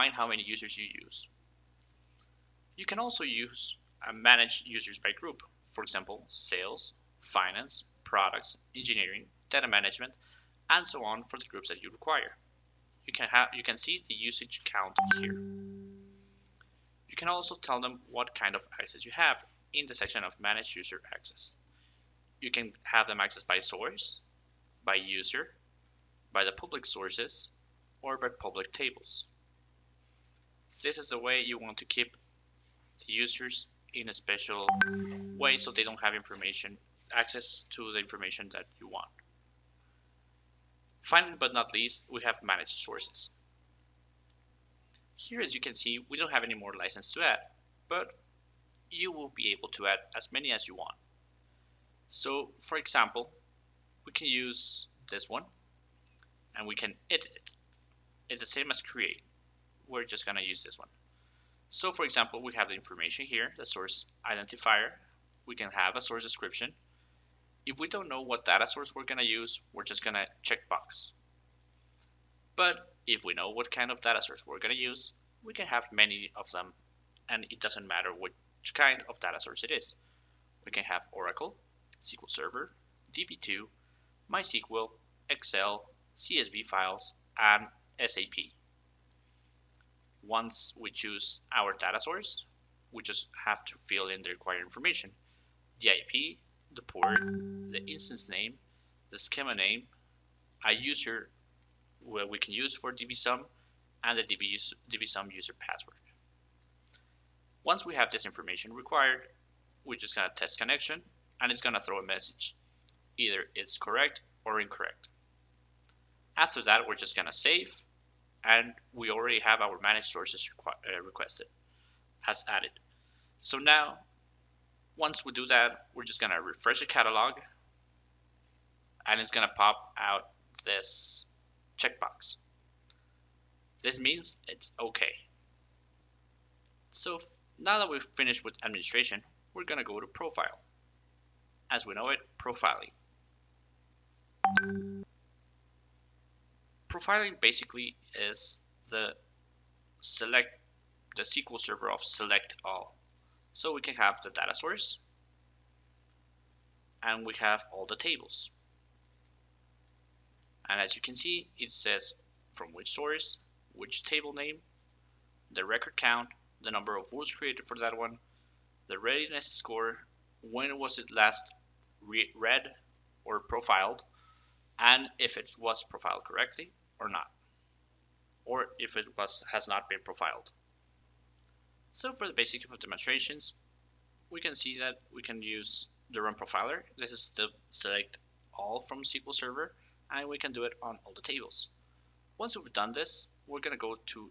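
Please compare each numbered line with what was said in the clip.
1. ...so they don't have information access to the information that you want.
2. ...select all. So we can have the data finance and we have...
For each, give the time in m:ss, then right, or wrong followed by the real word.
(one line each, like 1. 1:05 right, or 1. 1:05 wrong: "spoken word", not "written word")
1. 0:35 right
2. 2:32 wrong: "source", not "finance".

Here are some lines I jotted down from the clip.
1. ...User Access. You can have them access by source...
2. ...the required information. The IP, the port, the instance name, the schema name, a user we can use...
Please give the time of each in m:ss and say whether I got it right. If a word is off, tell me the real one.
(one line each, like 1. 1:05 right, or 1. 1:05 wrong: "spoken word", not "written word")
1. 0:20 right
2. 1:34 right.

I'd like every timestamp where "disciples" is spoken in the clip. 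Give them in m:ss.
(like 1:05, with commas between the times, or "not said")
not said.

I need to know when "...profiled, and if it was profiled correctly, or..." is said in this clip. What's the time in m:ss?
2:53.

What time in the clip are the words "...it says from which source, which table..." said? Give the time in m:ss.
2:41.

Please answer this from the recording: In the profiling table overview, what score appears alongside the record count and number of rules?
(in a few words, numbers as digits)
readiness score.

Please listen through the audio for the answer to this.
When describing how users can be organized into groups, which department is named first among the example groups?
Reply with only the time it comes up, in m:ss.
0:06.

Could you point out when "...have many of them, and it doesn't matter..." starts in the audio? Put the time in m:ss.
1:15.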